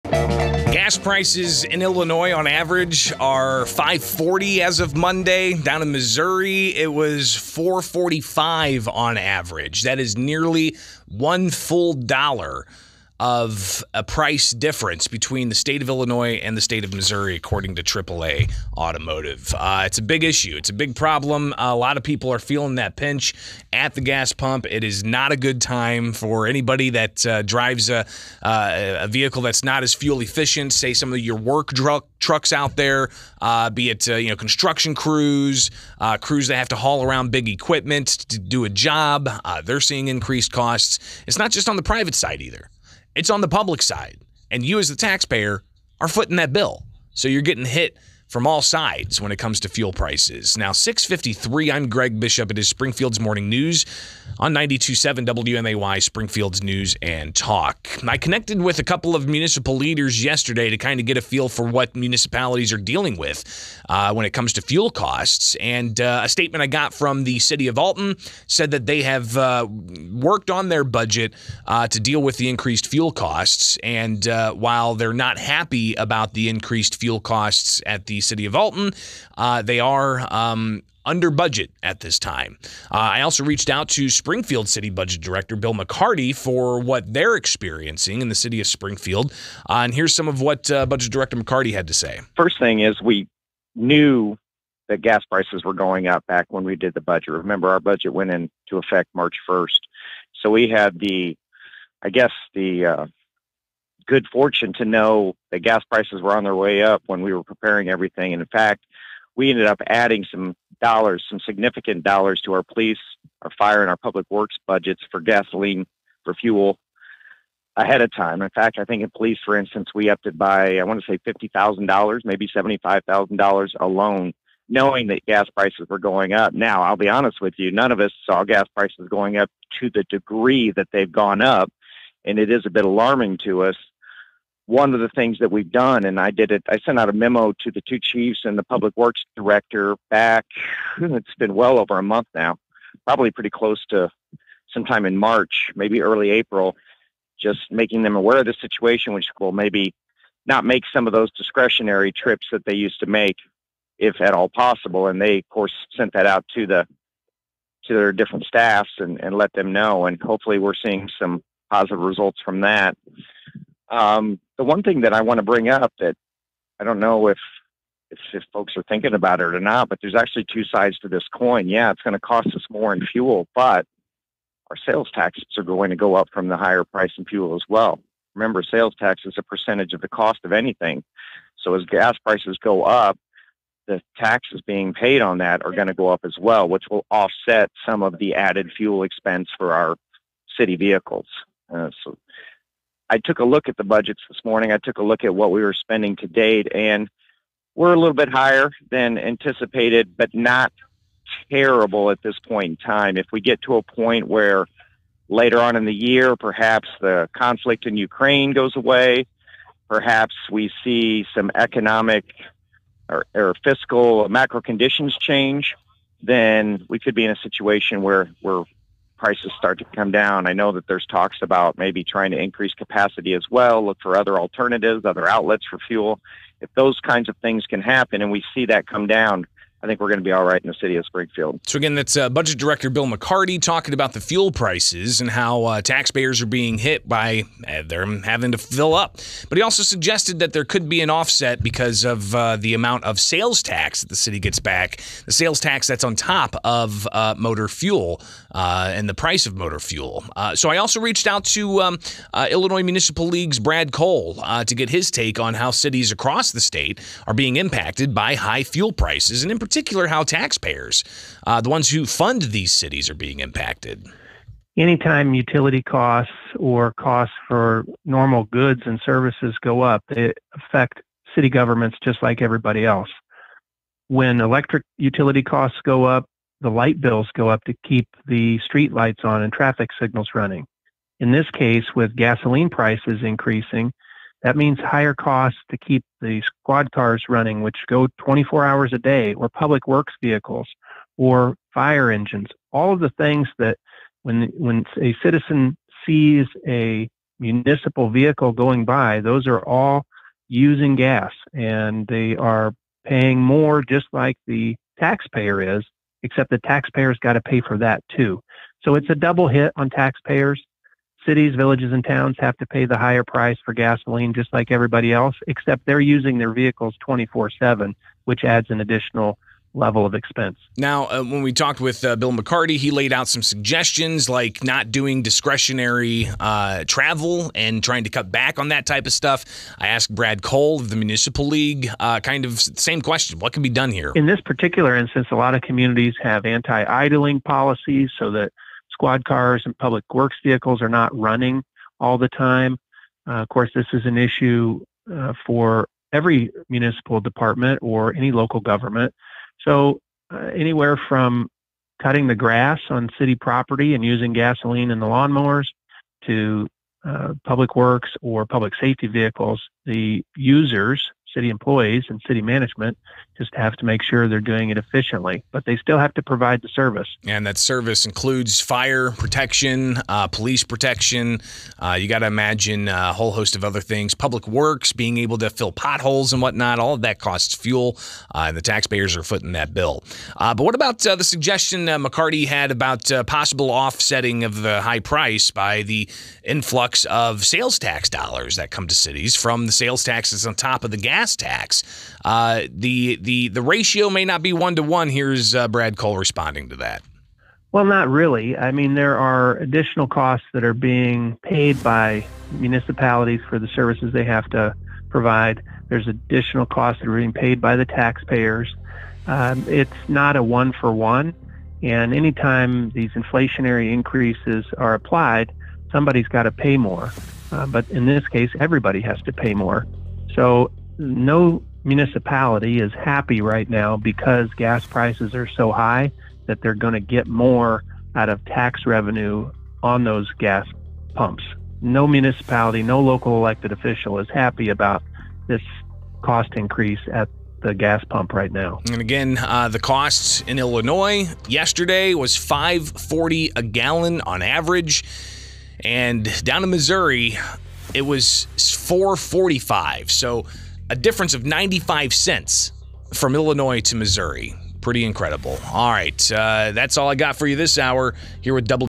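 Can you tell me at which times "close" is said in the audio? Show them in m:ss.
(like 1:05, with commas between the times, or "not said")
2:23.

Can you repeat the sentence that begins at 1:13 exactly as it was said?
And uh, while they're not happy about the increased fuel costs at the city of Alton.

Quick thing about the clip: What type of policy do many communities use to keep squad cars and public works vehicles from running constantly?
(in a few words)
Anti-idling policies.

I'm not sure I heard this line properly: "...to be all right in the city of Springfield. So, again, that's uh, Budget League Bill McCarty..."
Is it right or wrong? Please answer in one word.
wrong.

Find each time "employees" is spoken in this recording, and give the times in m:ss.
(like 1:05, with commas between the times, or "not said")
6:01.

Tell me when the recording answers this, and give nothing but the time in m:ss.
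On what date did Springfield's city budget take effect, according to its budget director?
1:39.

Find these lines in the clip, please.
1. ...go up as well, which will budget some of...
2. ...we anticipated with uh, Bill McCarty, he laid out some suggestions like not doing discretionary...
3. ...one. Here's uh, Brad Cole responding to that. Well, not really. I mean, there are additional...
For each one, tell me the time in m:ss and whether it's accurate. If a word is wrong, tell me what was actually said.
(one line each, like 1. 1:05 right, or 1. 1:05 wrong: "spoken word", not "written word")
1. 3:05 wrong: "offset", not "budget"
2. 5:21 wrong: "talked", not "anticipated"
3. 6:34 right.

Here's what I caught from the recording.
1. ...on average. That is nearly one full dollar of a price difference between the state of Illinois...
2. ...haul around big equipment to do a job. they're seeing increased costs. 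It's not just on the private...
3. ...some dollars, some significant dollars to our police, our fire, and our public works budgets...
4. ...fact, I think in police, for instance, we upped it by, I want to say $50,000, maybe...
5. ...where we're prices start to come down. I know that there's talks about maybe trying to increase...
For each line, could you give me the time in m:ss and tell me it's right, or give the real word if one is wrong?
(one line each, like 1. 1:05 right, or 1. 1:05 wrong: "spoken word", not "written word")
1. 0:08 right
2. 0:36 right
3. 1:50 right
4. 1:58 right
5. 3:38 right.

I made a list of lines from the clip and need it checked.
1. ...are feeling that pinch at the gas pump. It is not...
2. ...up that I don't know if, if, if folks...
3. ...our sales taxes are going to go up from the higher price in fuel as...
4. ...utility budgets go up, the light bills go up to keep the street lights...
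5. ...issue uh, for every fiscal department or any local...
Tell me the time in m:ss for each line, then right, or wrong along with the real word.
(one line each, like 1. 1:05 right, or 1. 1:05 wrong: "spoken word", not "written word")
1. 0:22 right
2. 2:45 right
3. 2:54 right
4. 4:34 wrong: "costs", not "budgets"
5. 5:44 wrong: "municipal", not "fiscal".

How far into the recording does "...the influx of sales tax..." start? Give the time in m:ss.
6:25.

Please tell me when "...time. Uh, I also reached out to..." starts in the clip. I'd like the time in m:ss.
1:22.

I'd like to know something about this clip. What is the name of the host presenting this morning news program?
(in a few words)
Greg Bishop.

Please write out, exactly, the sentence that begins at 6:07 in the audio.
And that service includes fire protection, uh, police protection.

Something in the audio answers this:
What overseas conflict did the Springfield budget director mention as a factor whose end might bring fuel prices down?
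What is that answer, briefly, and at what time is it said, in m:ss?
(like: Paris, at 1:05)
Ukraine, at 3:27.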